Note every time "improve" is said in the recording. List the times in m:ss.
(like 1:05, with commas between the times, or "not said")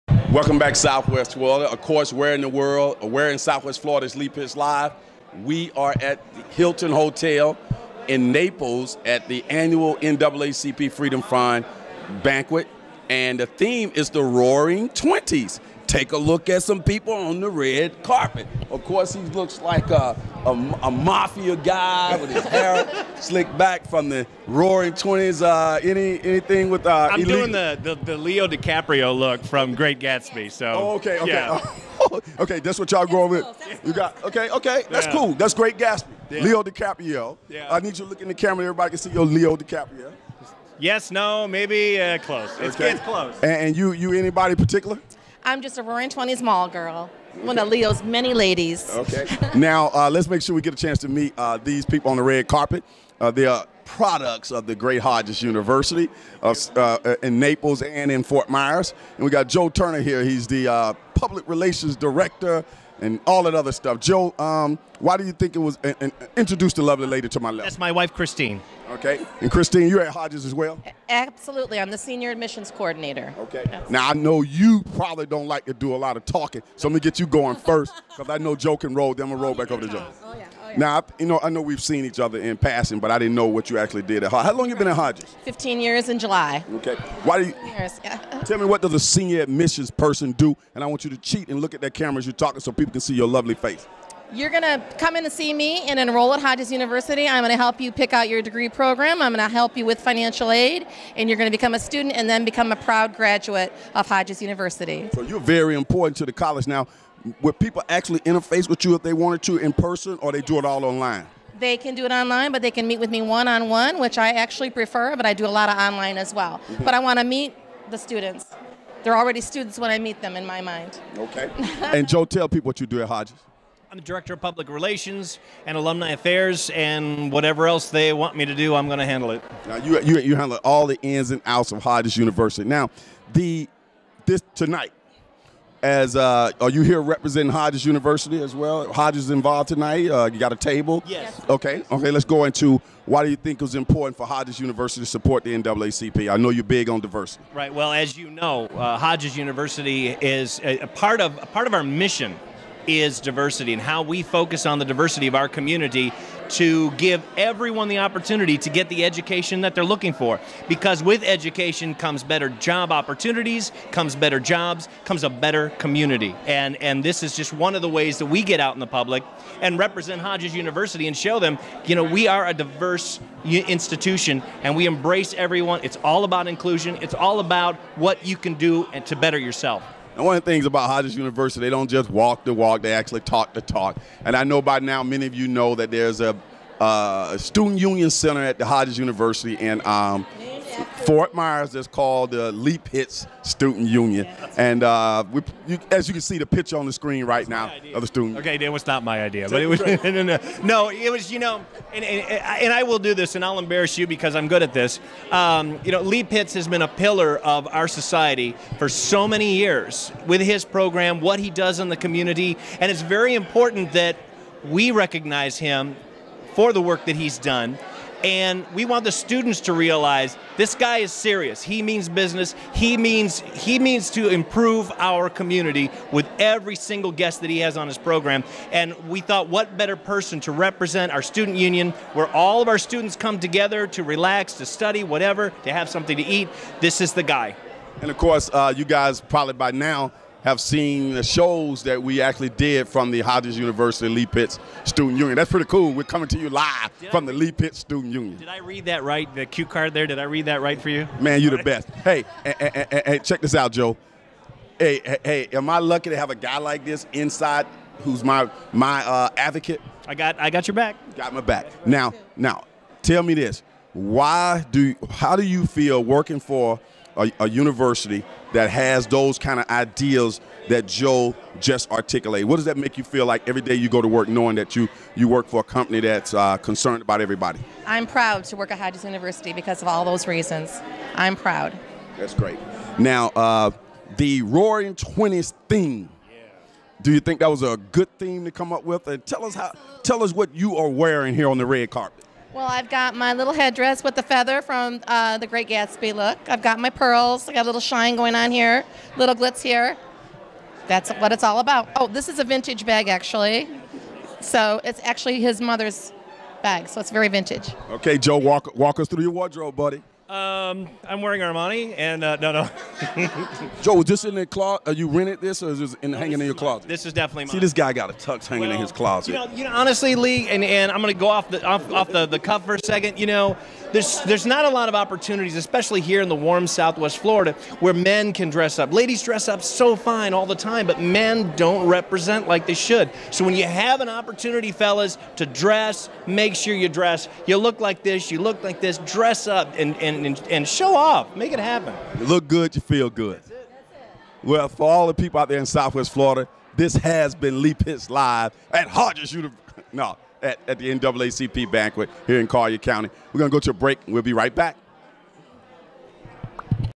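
3:44.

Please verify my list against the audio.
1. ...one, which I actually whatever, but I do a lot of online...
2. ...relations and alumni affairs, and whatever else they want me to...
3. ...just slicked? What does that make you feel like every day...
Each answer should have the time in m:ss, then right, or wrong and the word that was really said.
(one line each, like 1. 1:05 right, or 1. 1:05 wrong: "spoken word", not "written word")
1. 1:53 wrong: "prefer", not "whatever"
2. 2:04 right
3. 4:31 wrong: "articulated", not "slicked".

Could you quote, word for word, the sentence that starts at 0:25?
Uh, any anything with uh, I'm illegal?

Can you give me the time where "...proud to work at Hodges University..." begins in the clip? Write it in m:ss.
4:38.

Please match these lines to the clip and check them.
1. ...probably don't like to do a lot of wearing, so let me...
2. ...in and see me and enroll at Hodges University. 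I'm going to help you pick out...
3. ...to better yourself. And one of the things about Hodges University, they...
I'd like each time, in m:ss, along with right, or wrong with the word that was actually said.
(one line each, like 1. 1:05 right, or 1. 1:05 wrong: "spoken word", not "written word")
1. 1:14 wrong: "talking", not "wearing"
2. 1:35 right
3. 2:59 right.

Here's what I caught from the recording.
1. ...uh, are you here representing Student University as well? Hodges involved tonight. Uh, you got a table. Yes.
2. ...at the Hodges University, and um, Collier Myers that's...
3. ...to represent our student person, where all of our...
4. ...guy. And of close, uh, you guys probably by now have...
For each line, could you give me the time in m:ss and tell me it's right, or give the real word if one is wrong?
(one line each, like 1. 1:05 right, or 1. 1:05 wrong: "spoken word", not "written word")
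1. 2:16 wrong: "Hodges", not "Student"
2. 3:08 wrong: "Fort", not "Collier"
3. 3:50 wrong: "union", not "person"
4. 3:57 wrong: "course", not "close".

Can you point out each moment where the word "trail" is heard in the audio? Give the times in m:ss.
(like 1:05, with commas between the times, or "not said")
not said.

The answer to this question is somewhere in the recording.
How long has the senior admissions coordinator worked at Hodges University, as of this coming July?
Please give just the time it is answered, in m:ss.
1:25.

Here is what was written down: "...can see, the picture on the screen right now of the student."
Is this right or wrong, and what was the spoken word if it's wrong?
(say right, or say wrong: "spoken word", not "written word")
right.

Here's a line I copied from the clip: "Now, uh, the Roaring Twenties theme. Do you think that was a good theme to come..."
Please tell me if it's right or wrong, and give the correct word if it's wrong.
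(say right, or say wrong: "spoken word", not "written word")
right.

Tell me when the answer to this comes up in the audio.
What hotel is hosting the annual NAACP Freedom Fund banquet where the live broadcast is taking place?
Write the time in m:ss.
0:06.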